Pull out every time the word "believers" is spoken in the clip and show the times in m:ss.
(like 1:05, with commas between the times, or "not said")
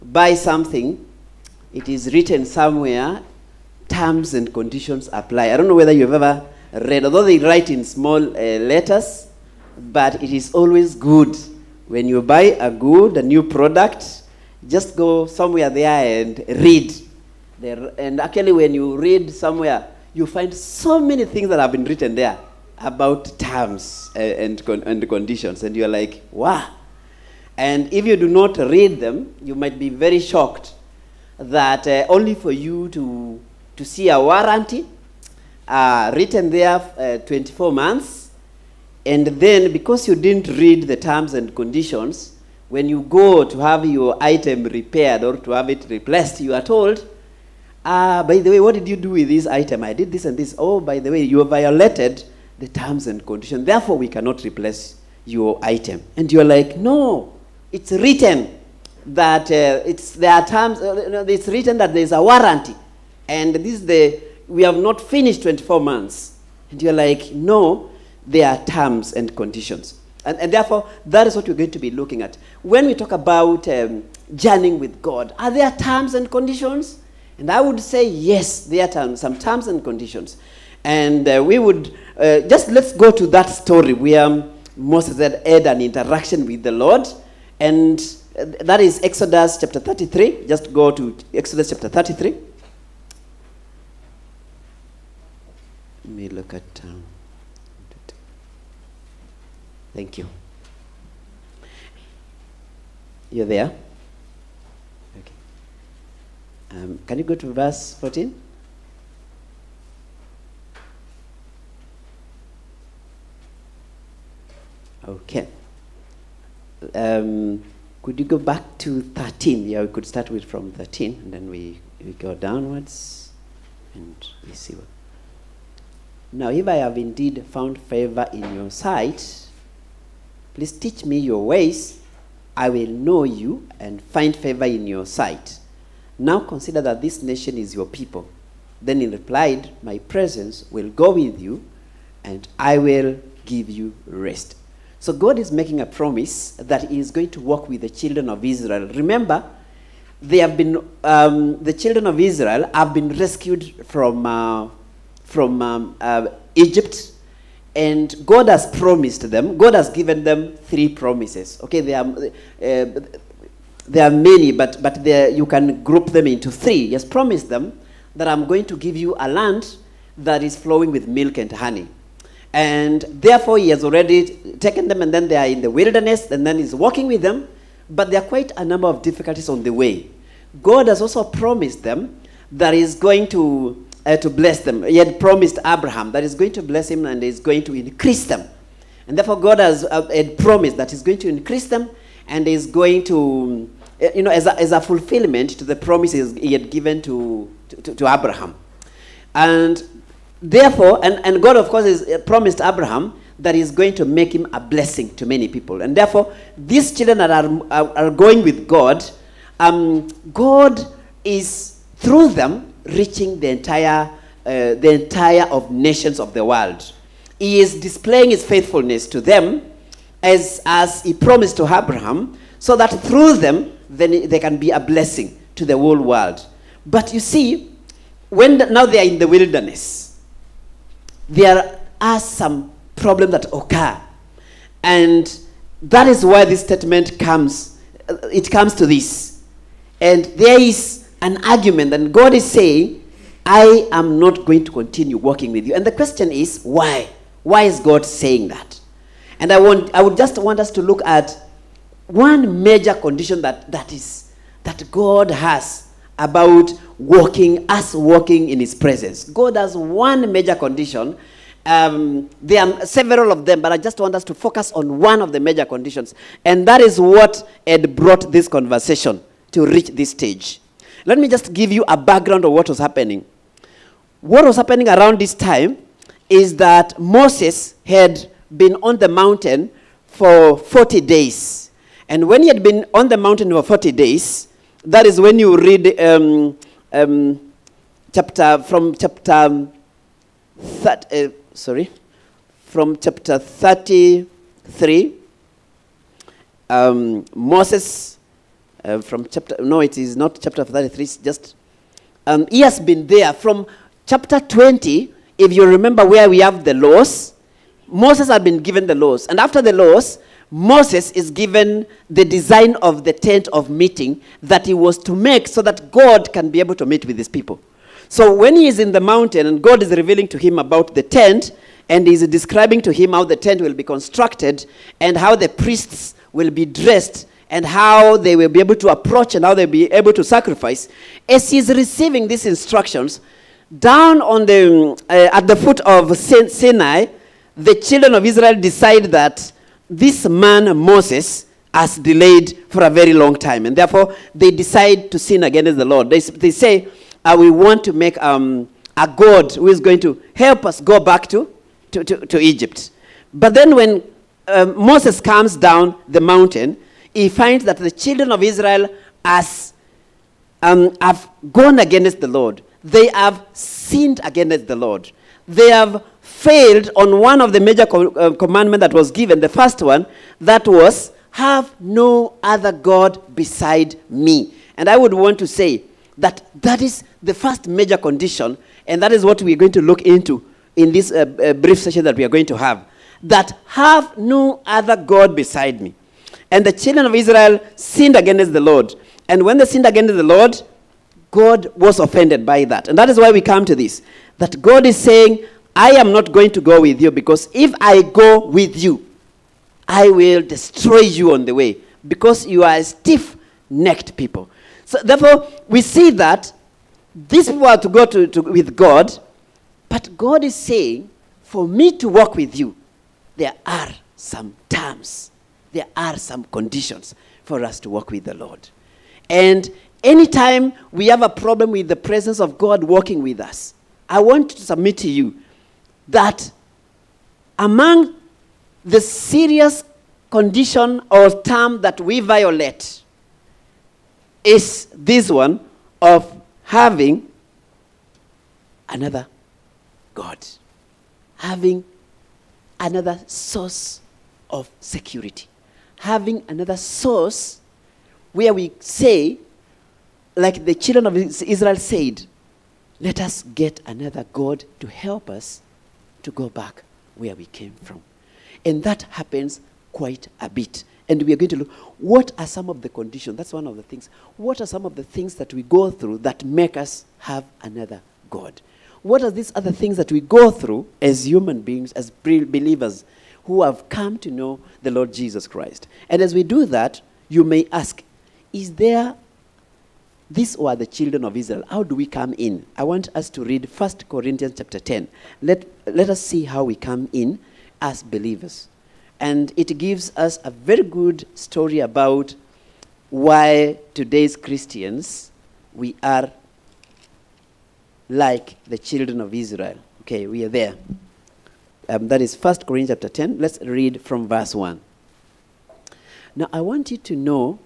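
7:52, 8:08.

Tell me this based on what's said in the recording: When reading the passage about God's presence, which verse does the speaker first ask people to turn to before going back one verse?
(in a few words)
14.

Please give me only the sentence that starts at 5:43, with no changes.
And therefore, they decide to sin against the Lord.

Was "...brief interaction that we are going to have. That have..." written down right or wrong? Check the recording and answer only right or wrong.
wrong.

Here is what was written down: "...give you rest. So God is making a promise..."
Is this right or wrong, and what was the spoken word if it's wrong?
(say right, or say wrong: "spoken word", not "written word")
right.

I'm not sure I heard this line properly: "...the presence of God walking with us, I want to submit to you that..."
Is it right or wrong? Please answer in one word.
right.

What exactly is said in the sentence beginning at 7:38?
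And that happens quite a bit.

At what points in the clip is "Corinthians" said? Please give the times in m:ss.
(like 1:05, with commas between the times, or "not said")
8:04, 8:22.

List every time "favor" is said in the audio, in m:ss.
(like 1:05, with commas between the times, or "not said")
2:07, 2:14.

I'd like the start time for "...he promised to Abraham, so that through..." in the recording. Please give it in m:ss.
3:41.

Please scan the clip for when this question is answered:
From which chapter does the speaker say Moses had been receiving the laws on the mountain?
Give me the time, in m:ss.
5:04.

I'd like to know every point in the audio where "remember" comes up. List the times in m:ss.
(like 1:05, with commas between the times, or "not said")
2:28, 5:05.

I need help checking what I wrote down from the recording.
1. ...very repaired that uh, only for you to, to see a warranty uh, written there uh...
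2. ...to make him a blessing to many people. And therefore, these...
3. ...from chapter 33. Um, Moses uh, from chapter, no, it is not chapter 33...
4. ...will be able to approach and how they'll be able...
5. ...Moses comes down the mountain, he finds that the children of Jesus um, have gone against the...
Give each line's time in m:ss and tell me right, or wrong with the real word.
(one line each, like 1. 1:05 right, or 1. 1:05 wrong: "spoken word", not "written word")
1. 0:29 wrong: "shocked", not "repaired"
2. 3:23 right
3. 4:52 right
4. 5:28 right
5. 5:54 wrong: "Israel", not "Jesus".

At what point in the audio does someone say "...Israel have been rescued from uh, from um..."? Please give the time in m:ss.
2:32.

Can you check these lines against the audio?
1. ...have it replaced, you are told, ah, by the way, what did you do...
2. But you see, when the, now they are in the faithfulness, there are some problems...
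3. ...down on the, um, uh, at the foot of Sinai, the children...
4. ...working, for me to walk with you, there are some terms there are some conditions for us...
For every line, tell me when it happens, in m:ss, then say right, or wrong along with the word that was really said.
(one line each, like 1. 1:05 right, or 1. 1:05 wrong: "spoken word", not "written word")
1. 0:45 right
2. 3:46 wrong: "wilderness", not "faithfulness"
3. 5:33 right
4. 6:50 wrong: "saying", not "working".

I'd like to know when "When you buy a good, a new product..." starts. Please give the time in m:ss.
0:11.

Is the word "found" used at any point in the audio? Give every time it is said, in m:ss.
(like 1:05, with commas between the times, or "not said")
2:07.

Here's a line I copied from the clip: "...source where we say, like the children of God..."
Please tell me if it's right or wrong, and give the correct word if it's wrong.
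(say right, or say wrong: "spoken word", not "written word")
wrong: "Israel", not "God".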